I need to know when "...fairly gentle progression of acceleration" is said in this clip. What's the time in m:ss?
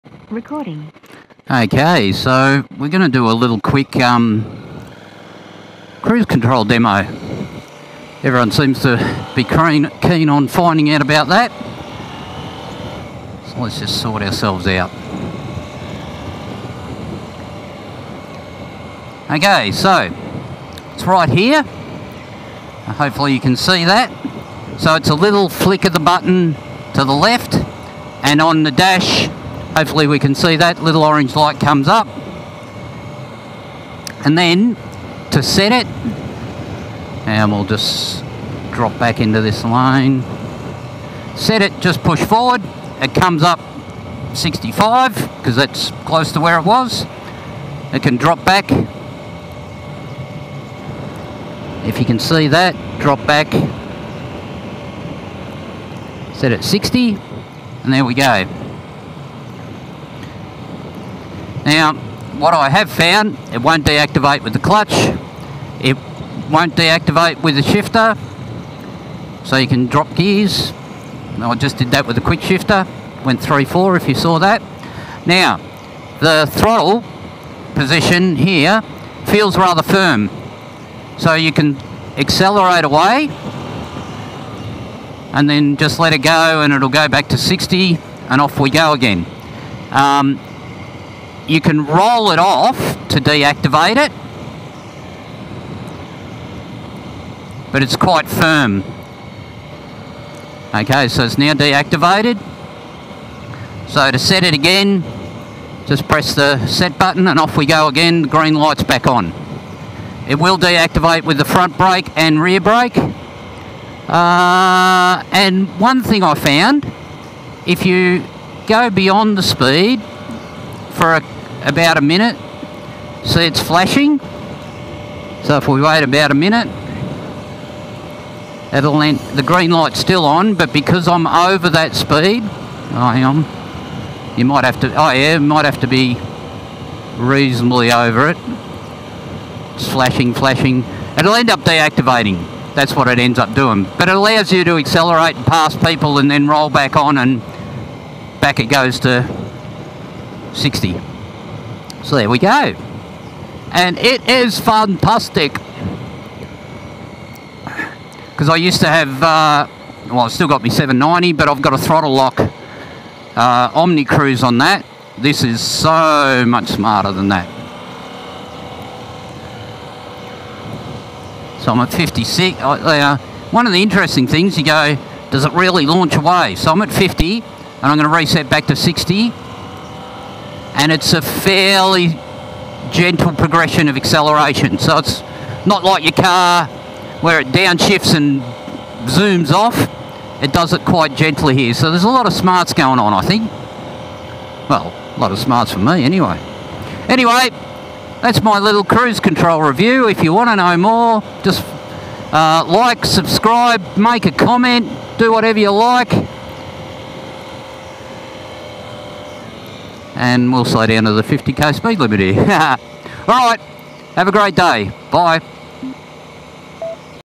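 3:01.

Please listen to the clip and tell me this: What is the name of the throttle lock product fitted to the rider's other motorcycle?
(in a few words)
Omni Cruise.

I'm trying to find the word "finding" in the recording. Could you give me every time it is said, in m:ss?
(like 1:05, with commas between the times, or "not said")
0:10.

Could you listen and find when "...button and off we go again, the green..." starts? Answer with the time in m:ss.
1:46.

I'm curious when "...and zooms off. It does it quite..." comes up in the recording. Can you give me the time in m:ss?
3:08.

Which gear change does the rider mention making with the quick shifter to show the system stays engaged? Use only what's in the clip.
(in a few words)
3-4.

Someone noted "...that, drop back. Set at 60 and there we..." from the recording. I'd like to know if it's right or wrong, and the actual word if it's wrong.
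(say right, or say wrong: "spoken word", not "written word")
right.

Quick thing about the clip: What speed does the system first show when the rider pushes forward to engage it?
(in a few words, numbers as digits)
65.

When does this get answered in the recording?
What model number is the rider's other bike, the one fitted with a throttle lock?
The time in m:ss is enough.
2:40.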